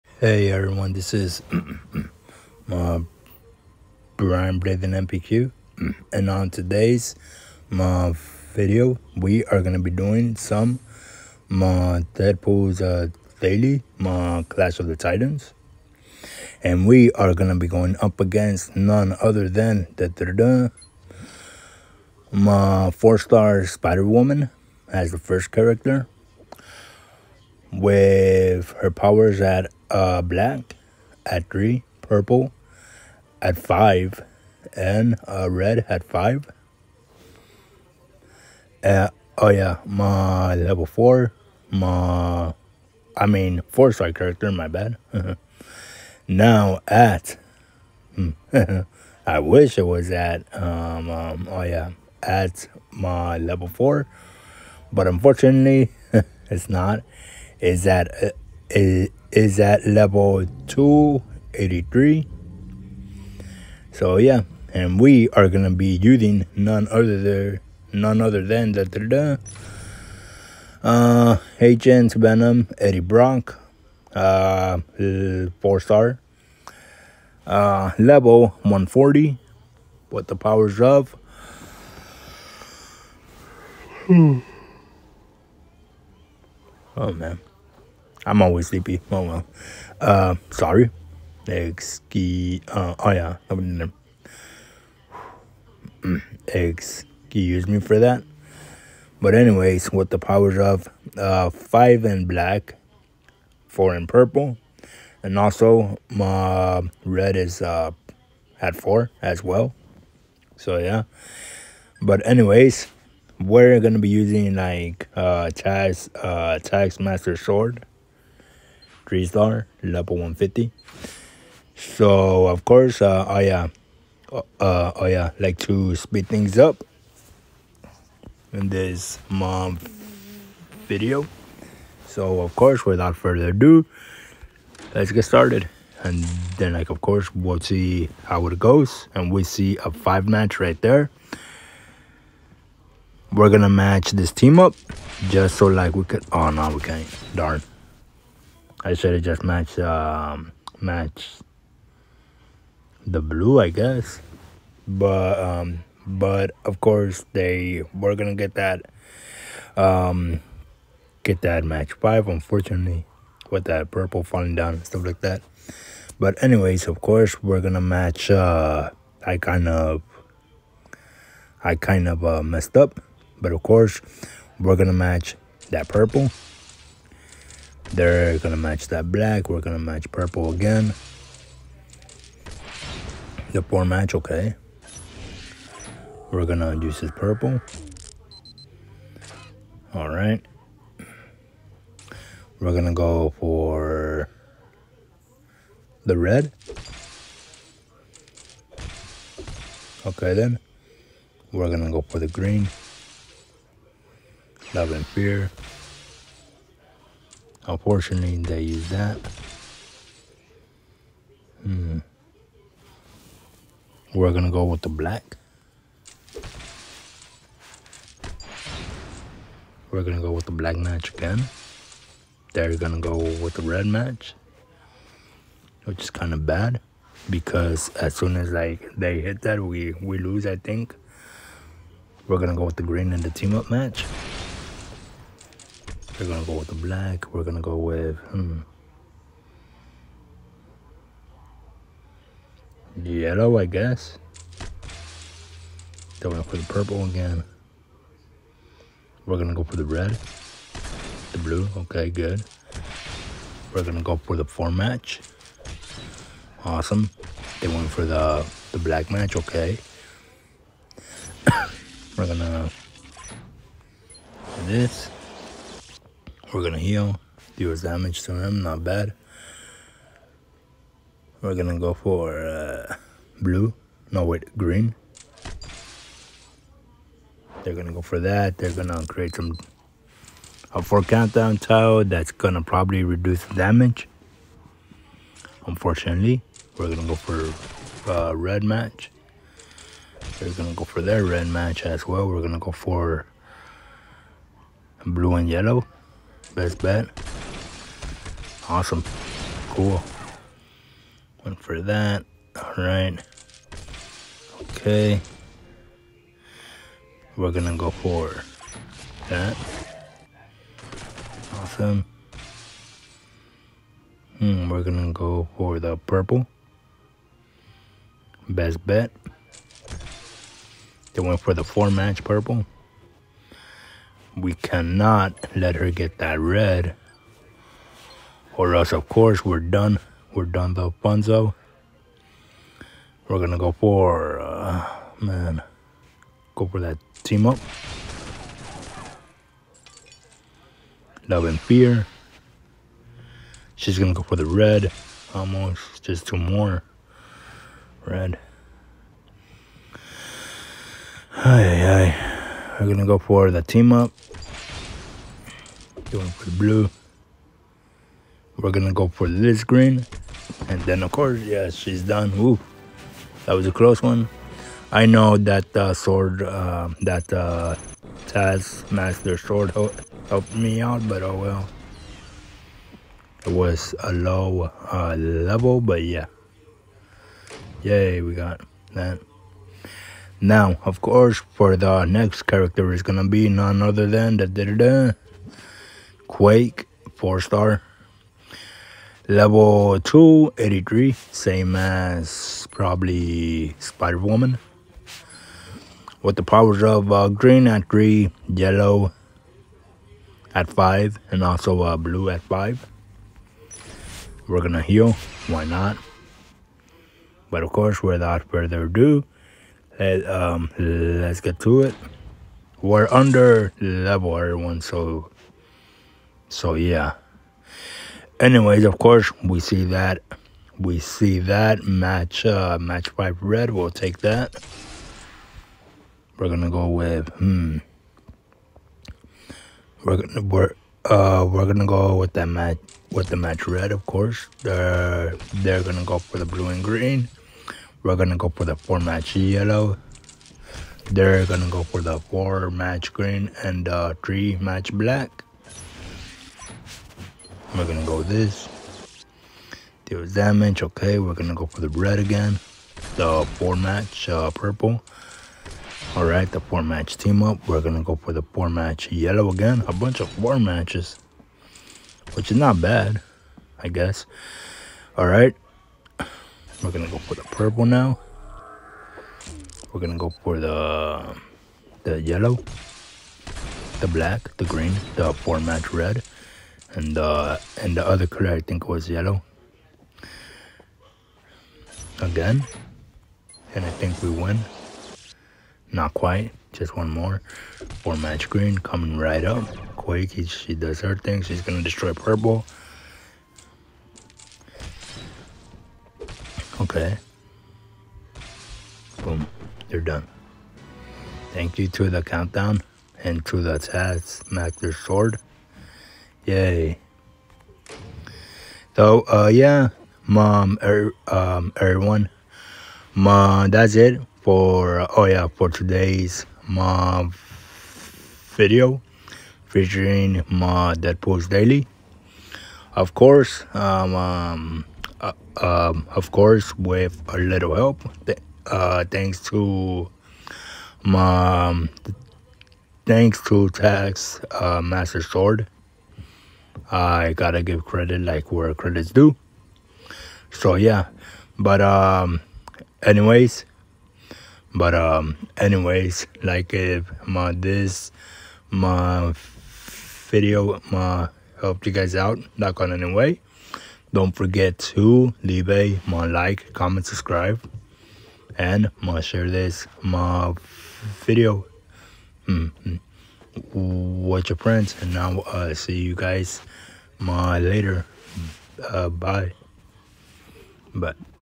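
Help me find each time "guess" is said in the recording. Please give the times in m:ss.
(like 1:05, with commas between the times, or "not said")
2:33, 4:03, 7:43.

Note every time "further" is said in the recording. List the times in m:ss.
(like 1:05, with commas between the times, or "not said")
2:13, 6:48.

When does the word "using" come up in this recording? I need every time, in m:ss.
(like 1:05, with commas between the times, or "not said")
1:05, 1:54.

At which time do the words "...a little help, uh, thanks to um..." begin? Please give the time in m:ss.
8:47.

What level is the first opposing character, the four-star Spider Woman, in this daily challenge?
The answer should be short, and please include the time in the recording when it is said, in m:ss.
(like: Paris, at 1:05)
283, at 0:59.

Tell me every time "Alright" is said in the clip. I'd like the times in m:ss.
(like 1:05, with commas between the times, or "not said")
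3:09, 5:02.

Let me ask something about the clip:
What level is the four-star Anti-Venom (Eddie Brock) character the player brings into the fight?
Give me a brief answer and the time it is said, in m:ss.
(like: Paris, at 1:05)
140, at 1:17.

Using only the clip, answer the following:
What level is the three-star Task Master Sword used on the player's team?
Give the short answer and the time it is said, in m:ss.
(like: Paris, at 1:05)
150, at 1:59.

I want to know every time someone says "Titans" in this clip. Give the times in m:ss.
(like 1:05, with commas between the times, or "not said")
0:14.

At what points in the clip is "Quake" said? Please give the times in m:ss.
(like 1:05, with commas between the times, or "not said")
6:26, 8:09.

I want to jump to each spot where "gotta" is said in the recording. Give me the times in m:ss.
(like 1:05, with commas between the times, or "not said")
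8:57.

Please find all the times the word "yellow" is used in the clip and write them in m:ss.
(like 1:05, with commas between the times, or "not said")
4:03, 4:55, 6:38, 7:19, 7:39, 7:52, 7:59.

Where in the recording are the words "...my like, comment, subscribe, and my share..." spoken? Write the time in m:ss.
9:16.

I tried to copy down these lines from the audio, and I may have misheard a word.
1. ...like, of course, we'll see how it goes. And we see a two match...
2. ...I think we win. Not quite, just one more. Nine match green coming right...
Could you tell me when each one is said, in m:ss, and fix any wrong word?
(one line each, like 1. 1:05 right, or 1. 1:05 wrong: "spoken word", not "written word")
1. 2:16 wrong: "five", not "two"
2. 8:03 wrong: "Four", not "Nine".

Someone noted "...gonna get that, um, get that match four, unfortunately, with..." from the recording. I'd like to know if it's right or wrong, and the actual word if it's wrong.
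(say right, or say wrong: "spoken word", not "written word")
wrong: "five", not "four".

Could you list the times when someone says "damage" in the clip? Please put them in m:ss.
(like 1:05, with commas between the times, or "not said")
4:27, 4:43, 7:30.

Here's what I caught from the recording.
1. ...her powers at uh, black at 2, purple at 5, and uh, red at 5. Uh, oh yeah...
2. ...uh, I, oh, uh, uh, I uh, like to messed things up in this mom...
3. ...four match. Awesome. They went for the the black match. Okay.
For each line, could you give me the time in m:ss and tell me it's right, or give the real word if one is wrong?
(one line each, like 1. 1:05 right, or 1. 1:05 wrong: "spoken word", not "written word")
1. 0:28 wrong: "3", not "2"
2. 2:03 wrong: "speed", not "messed"
3. 4:14 right.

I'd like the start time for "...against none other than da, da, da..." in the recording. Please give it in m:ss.
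0:18.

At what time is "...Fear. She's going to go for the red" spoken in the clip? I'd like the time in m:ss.
5:41.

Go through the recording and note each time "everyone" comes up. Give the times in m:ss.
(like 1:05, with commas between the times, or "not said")
0:00, 6:54, 8:31.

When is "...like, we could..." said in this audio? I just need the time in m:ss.
2:25.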